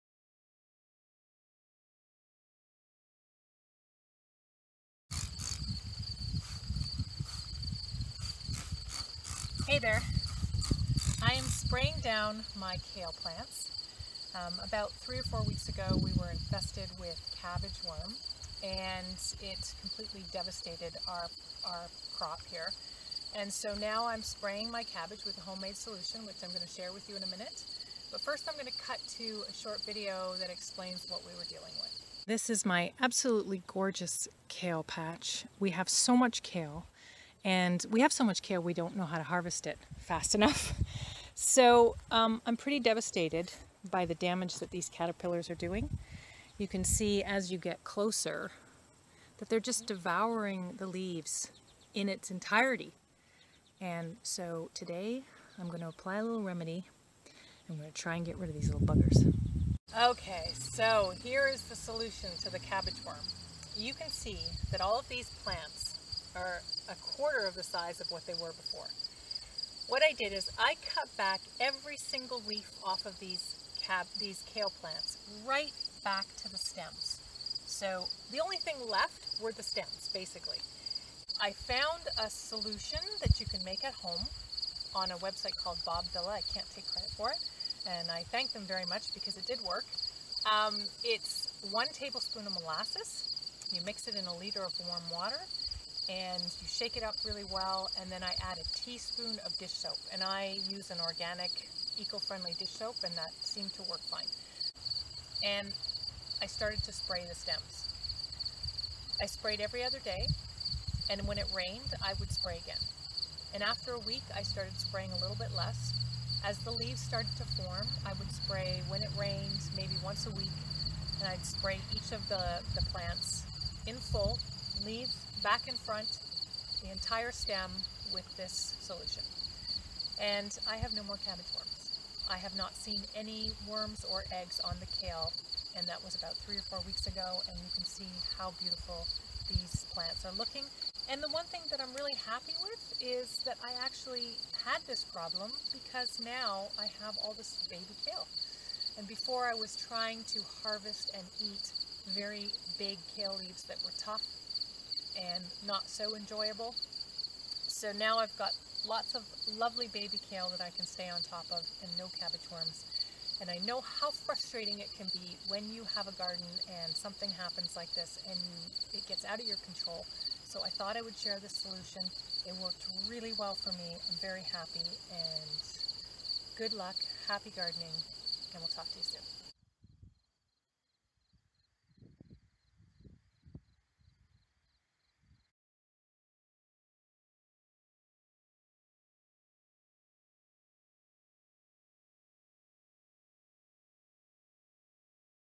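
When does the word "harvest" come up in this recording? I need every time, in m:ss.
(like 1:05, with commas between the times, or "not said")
0:39, 2:30.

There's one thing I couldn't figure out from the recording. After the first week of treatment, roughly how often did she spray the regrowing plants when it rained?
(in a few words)
once a week.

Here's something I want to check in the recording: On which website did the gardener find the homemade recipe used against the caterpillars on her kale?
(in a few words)
Bob Vila.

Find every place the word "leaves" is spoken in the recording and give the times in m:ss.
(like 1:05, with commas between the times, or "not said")
0:50, 1:56, 2:04, 2:33.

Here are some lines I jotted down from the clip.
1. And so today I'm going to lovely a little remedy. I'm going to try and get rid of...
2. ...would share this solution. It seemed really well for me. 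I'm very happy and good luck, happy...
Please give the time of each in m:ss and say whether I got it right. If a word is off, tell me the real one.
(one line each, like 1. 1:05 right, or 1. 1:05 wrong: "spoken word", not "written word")
1. 0:53 wrong: "apply", not "lovely"
2. 2:51 wrong: "worked", not "seemed".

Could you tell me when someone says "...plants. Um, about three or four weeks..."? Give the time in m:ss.
0:13.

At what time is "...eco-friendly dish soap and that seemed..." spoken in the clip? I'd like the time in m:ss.
1:41.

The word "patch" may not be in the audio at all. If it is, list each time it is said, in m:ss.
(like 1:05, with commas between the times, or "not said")
0:34.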